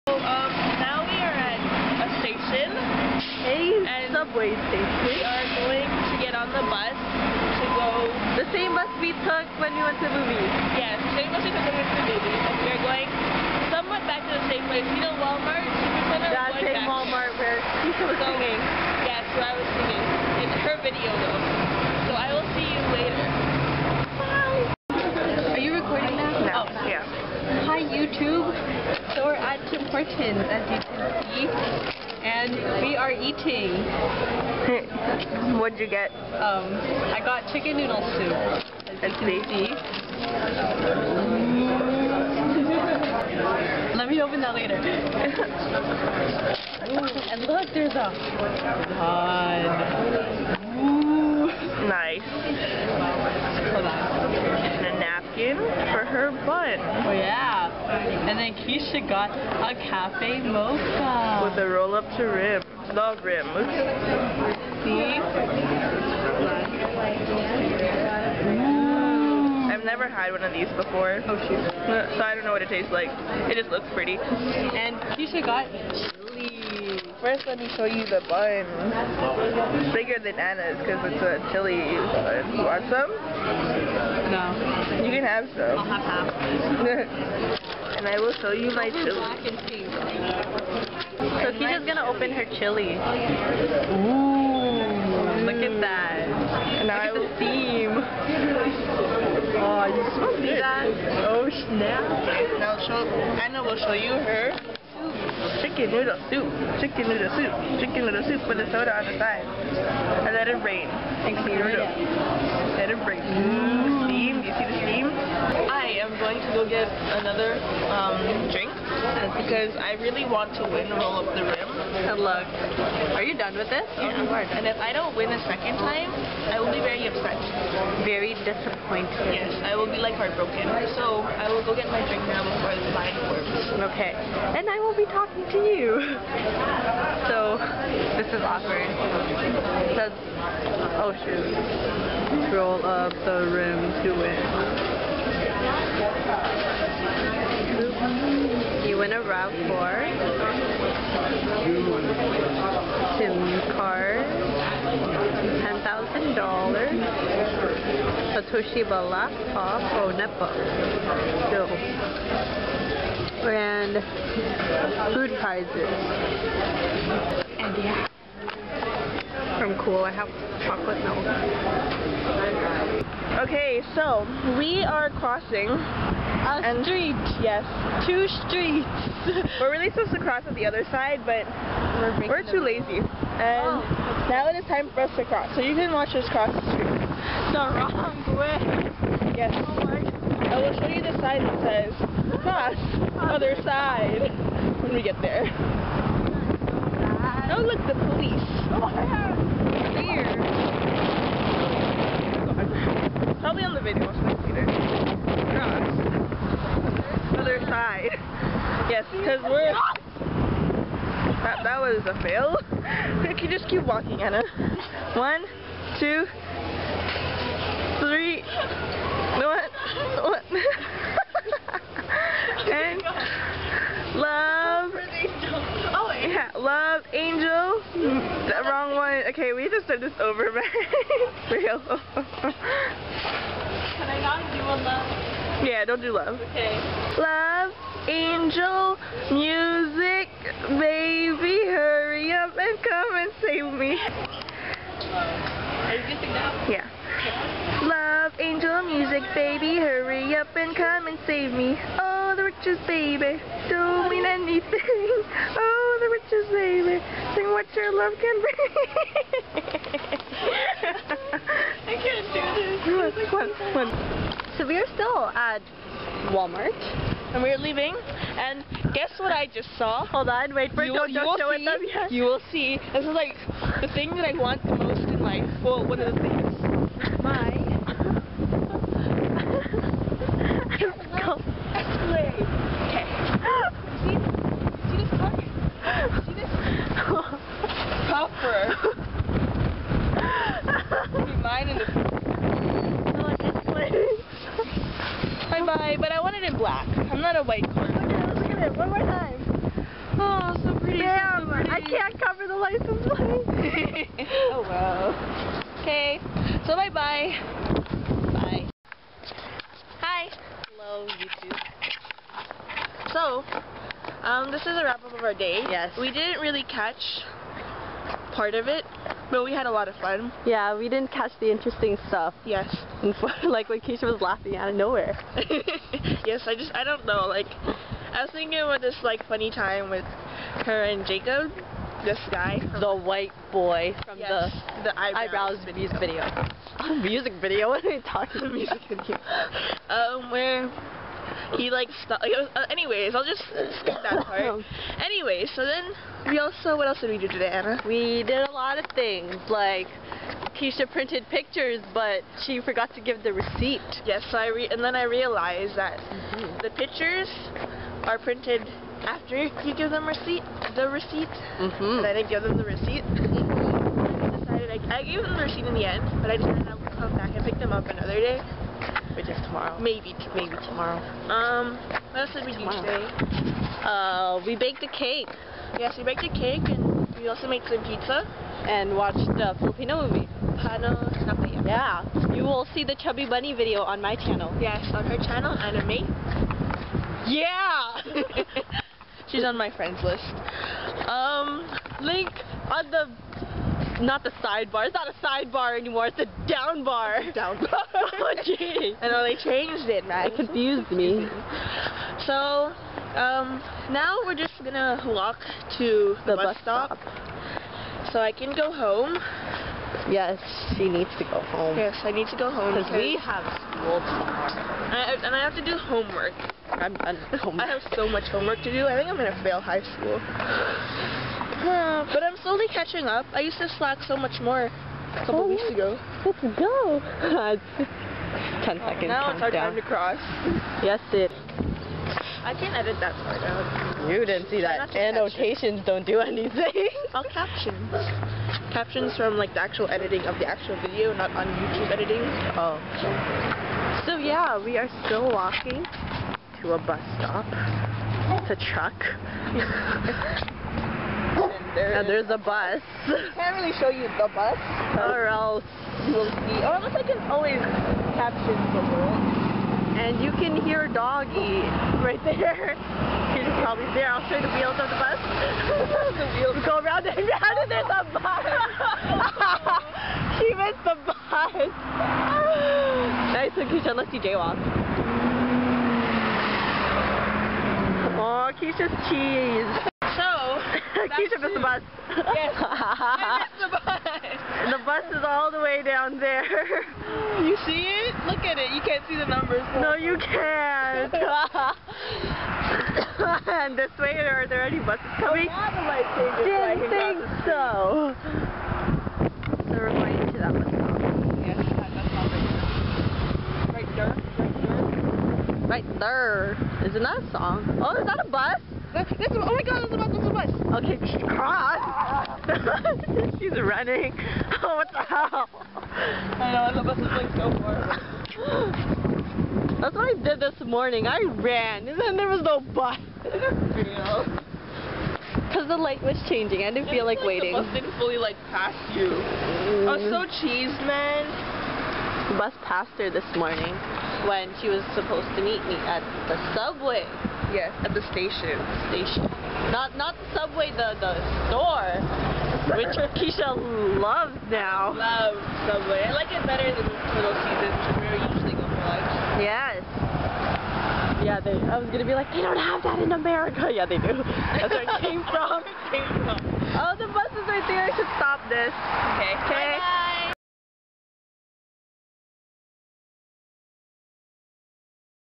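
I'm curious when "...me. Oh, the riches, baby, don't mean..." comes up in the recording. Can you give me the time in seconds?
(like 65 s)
251 s.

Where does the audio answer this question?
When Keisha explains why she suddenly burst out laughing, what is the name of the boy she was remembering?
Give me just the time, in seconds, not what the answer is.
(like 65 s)
331 s.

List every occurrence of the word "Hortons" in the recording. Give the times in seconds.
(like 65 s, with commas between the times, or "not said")
29 s.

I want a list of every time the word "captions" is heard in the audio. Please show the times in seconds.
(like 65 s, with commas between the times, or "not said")
438 s, 458 s.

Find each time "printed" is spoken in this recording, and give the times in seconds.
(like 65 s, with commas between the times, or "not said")
350 s, 358 s.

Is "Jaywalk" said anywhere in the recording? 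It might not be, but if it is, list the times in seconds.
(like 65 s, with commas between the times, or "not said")
474 s.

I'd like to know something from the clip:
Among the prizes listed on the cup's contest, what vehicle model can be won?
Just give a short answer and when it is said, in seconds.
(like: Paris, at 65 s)
RAV4, at 149 s.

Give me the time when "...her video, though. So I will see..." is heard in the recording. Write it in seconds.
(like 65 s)
20 s.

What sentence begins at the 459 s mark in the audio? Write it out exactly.
And you can hear Doggy right there.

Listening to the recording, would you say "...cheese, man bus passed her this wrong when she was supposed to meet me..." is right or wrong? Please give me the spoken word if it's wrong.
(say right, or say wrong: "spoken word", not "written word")
wrong: "morning", not "wrong".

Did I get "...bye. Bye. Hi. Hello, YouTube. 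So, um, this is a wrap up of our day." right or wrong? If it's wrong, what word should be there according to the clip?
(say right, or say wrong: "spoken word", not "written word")
right.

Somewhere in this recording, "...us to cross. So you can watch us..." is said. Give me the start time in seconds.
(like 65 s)
185 s.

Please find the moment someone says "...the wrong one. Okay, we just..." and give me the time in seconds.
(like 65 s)
228 s.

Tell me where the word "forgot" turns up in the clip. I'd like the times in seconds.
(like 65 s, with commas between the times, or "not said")
352 s.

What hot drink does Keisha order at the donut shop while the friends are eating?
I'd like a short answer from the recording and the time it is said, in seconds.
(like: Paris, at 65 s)
Cafe mocha, at 59 s.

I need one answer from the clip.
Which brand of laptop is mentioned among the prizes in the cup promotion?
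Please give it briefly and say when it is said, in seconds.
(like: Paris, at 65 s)
Toshiba, at 158 s.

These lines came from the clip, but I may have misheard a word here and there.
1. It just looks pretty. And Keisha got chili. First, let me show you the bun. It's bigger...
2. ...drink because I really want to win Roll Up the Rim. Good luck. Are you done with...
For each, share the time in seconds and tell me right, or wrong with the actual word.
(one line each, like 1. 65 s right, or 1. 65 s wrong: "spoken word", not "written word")
1. 73 s right
2. 118 s right.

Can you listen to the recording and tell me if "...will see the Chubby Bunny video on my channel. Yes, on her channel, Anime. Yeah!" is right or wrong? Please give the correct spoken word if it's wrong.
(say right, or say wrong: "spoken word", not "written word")
right.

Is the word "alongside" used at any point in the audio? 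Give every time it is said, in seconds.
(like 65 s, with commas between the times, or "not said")
not said.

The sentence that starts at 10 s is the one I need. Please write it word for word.
Yes, yeah, same bus we took when we went to the movies.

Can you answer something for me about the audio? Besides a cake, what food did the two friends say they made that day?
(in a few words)
Pizza.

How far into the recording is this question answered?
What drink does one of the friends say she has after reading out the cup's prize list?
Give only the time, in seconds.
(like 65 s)
170 s.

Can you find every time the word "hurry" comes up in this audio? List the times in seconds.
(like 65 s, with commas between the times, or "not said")
241 s, 249 s.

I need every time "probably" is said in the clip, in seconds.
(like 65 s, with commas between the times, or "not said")
203 s, 463 s.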